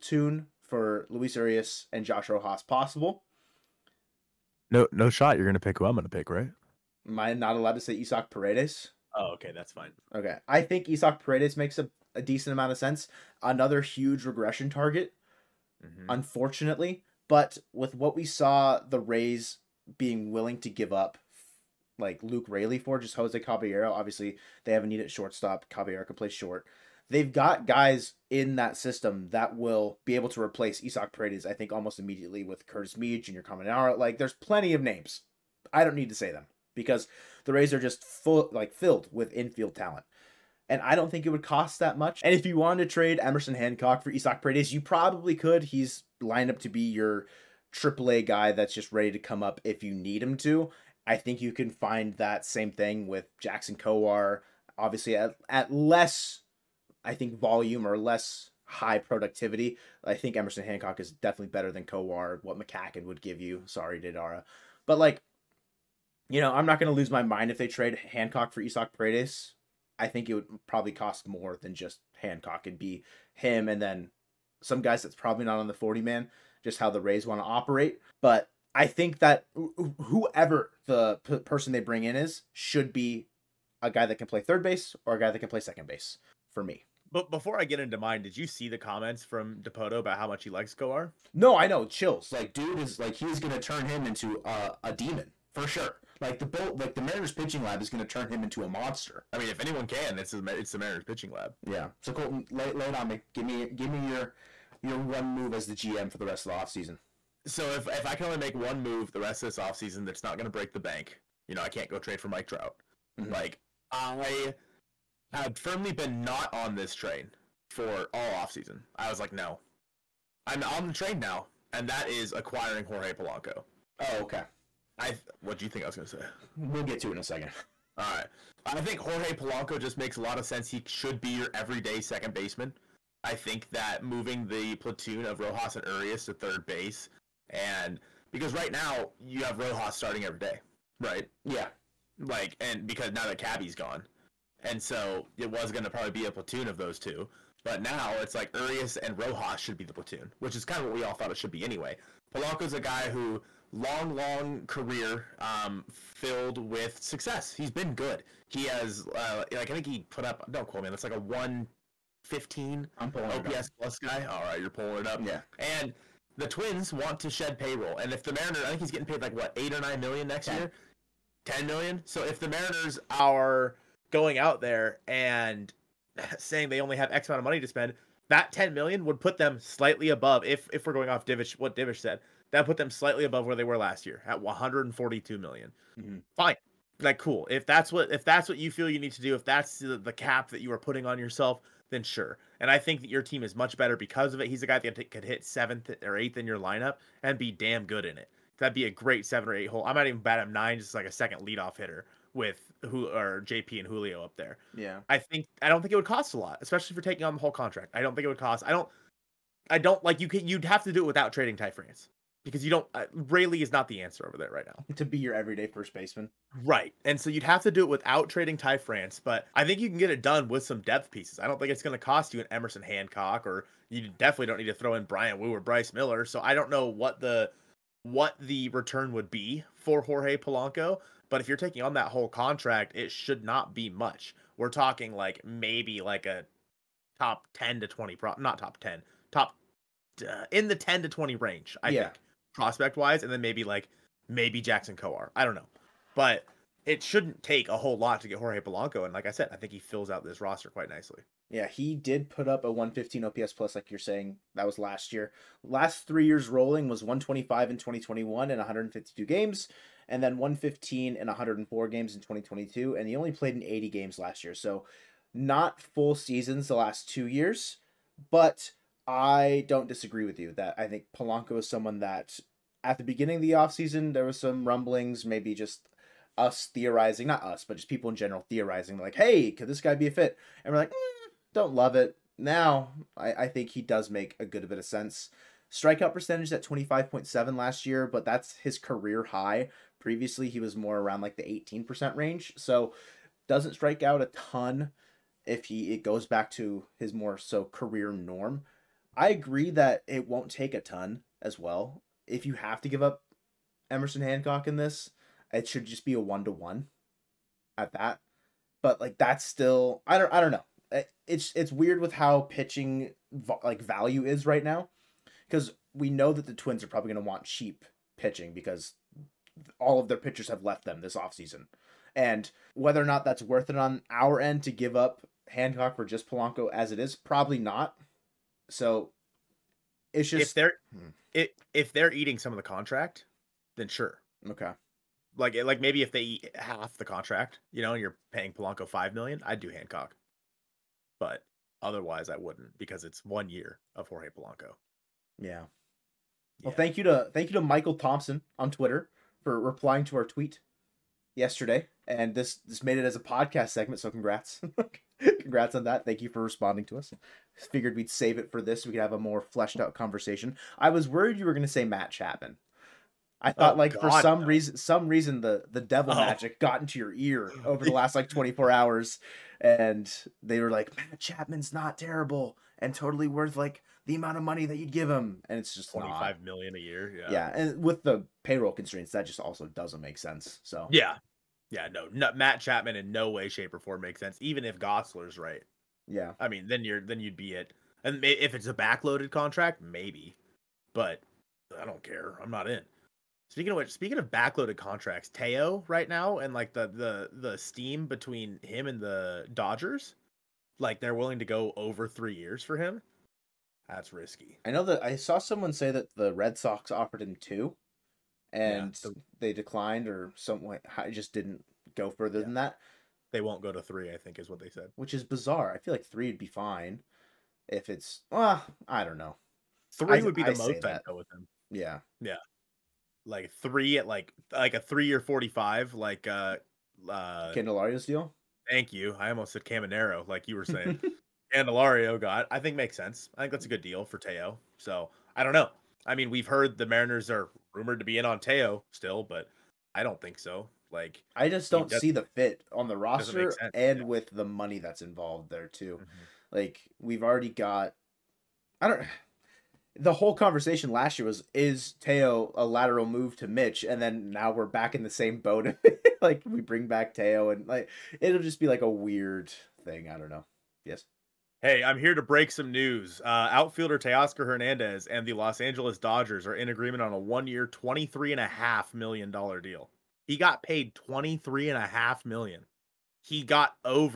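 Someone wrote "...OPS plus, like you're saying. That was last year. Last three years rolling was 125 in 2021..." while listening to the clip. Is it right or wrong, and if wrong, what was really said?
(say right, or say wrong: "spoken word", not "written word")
right.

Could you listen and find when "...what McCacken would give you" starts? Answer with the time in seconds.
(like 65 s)
62 s.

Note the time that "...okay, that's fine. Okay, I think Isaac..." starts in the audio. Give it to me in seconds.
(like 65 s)
9 s.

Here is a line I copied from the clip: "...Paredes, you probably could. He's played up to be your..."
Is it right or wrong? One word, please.
wrong.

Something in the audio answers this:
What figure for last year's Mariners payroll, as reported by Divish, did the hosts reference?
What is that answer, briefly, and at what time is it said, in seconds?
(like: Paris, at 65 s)
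142 million, at 184 s.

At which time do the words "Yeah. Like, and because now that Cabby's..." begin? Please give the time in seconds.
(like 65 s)
141 s.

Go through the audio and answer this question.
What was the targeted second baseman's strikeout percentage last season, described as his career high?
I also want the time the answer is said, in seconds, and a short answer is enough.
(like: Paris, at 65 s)
25.7, at 286 s.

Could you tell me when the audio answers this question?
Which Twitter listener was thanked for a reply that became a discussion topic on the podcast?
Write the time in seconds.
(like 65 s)
347 s.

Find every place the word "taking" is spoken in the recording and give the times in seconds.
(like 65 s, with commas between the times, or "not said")
207 s, 231 s.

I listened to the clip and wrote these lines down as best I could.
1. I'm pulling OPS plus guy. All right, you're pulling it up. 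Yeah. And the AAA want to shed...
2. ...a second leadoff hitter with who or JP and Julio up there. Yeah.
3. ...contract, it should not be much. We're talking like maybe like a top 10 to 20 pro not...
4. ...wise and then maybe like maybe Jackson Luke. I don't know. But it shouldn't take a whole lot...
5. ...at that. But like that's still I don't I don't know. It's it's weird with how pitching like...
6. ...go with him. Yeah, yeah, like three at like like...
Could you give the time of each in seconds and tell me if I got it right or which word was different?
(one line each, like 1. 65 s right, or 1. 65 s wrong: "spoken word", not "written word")
1. 162 s wrong: "Twins", not "AAA"
2. 201 s right
3. 232 s right
4. 242 s wrong: "Kowar", not "Luke"
5. 307 s right
6. 421 s right.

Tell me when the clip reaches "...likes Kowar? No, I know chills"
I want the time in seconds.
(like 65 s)
90 s.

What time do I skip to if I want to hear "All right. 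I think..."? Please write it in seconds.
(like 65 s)
127 s.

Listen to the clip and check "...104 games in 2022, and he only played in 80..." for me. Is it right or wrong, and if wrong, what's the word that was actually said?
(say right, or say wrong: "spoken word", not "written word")
right.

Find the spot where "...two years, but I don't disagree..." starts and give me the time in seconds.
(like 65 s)
267 s.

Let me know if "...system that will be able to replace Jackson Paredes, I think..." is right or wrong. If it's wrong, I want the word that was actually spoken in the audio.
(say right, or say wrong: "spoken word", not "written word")
wrong: "Isaac", not "Jackson".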